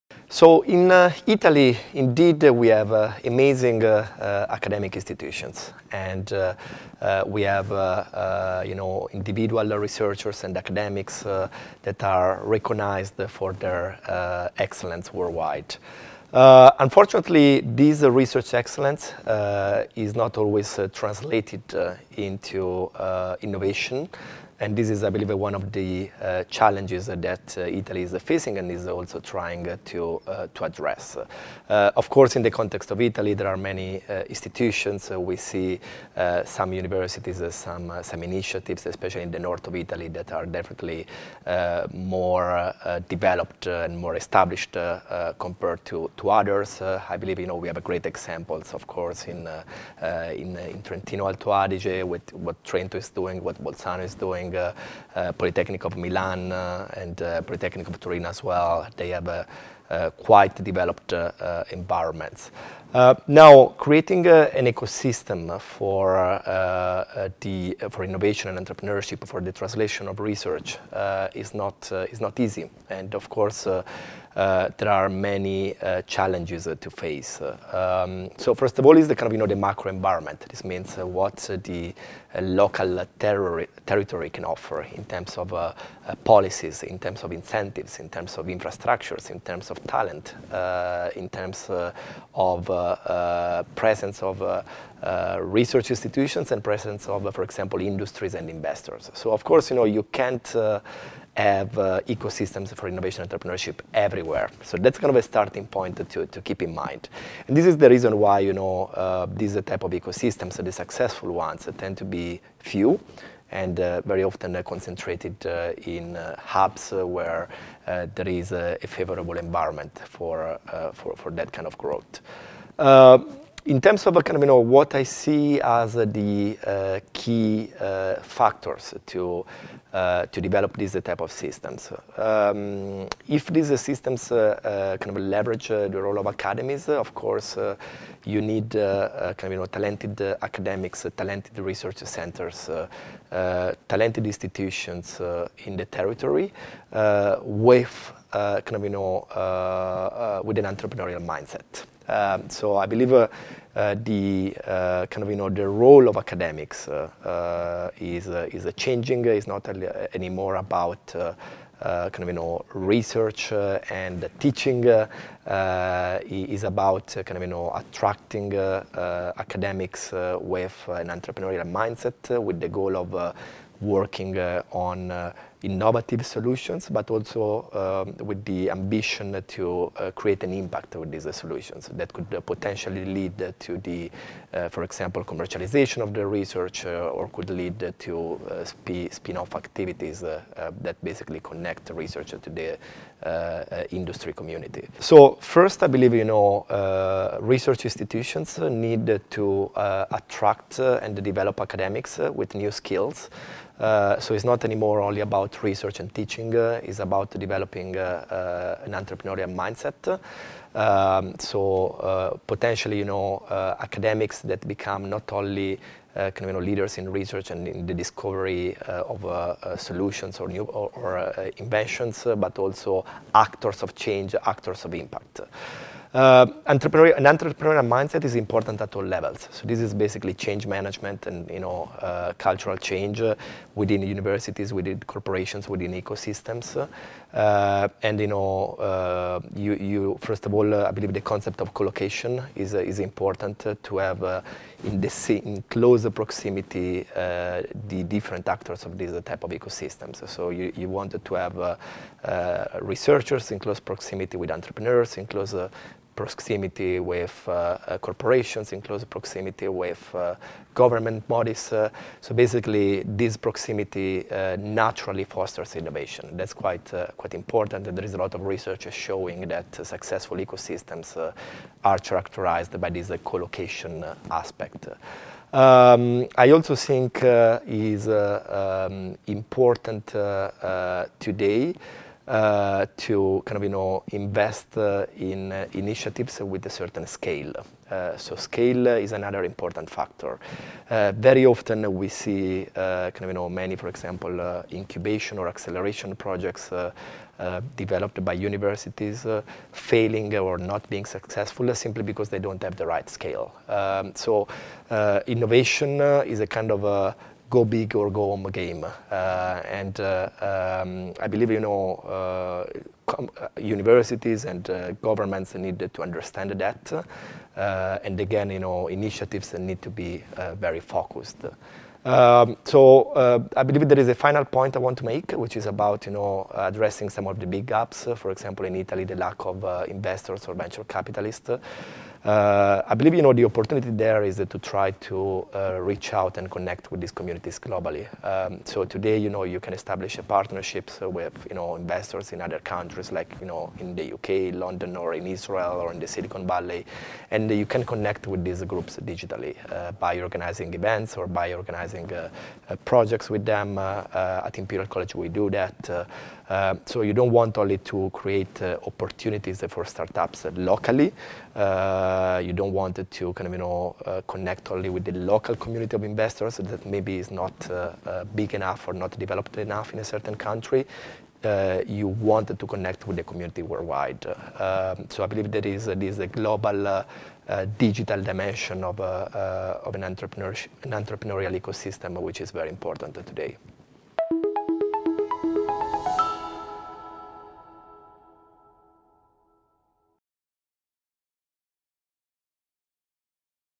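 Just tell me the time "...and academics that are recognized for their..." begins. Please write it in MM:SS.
00:10.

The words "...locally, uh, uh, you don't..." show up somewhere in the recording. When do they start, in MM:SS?
06:00.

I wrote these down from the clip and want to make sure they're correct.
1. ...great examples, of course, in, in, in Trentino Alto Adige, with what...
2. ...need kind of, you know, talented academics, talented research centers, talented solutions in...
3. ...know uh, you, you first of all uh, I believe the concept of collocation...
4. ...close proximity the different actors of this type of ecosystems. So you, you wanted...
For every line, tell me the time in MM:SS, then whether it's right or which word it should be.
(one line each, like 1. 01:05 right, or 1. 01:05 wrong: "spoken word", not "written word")
1. 00:47 right
2. 02:18 wrong: "institutions", not "solutions"
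3. 03:58 right
4. 04:05 right.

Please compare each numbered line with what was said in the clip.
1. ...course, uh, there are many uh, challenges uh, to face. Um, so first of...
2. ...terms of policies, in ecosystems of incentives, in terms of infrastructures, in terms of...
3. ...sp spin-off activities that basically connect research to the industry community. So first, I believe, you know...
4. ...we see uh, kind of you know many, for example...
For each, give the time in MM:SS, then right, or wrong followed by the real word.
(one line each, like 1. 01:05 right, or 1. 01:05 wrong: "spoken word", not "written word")
1. 01:13 right
2. 01:25 wrong: "terms", not "ecosystems"
3. 03:08 right
4. 04:51 right.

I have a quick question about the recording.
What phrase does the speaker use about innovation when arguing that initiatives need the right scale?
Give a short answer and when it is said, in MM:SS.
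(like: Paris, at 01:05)
Go big or go home, at 05:07.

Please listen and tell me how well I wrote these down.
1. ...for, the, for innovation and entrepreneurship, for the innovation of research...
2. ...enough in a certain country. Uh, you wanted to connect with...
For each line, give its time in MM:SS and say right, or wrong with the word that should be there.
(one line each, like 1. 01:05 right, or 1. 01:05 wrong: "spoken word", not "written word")
1. 01:05 wrong: "translation", not "innovation"
2. 06:09 right.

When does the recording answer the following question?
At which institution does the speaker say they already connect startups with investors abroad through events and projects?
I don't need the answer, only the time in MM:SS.
05:54.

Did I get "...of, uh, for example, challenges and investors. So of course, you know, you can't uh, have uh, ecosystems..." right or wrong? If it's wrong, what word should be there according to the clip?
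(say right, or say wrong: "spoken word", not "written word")
wrong: "industries", not "challenges".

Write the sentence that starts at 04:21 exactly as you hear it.
Uh, so basically, this proximity uh, naturally fosters innovation.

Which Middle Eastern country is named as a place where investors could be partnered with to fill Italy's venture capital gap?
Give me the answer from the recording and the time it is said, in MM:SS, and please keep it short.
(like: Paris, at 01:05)
Israel, at 05:45.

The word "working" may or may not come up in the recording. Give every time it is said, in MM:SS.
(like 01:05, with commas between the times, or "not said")
02:53.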